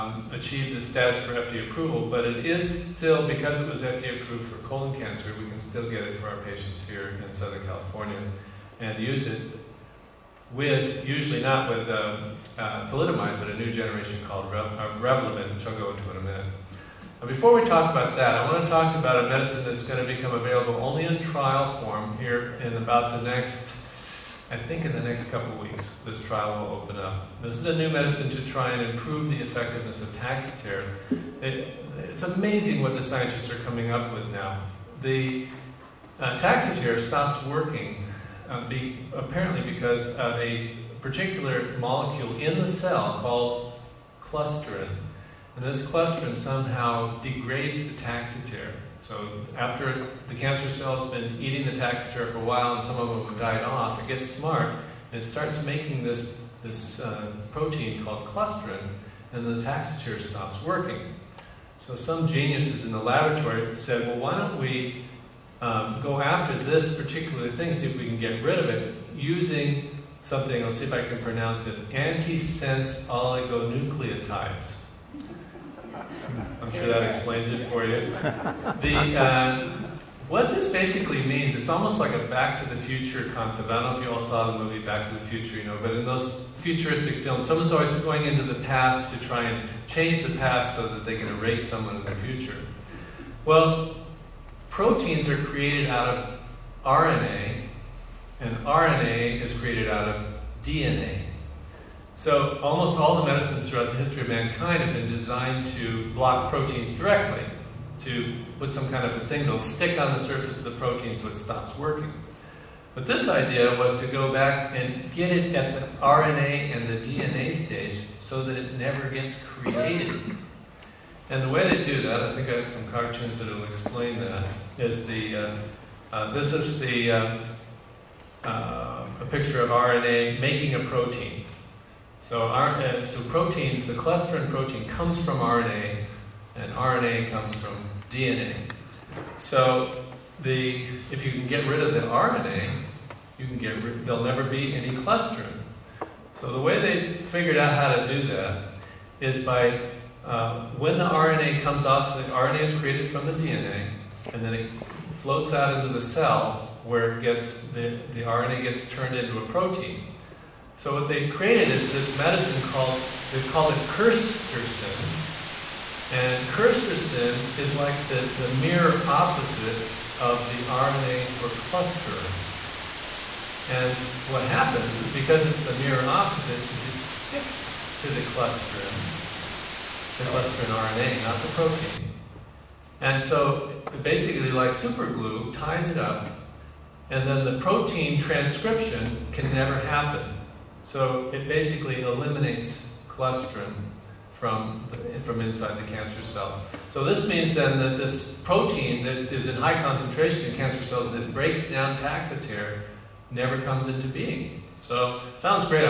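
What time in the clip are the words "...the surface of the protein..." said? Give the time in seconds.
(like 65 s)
110 s.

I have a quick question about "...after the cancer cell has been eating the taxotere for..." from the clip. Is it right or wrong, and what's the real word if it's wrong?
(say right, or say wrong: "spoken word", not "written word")
right.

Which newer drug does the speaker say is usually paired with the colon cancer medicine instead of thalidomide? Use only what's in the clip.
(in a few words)
Revlimid.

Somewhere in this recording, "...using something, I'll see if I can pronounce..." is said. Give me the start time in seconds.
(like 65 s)
69 s.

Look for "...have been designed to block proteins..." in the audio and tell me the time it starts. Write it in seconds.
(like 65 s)
104 s.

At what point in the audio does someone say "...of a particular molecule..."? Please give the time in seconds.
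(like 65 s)
40 s.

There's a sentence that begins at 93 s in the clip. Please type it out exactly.
Well, proteins are created out of RNA, and RNA is created out of DNA.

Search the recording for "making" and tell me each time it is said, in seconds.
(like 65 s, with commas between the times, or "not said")
55 s, 130 s.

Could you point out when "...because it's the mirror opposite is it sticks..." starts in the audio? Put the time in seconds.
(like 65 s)
175 s.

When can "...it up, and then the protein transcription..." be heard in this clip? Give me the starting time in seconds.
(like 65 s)
185 s.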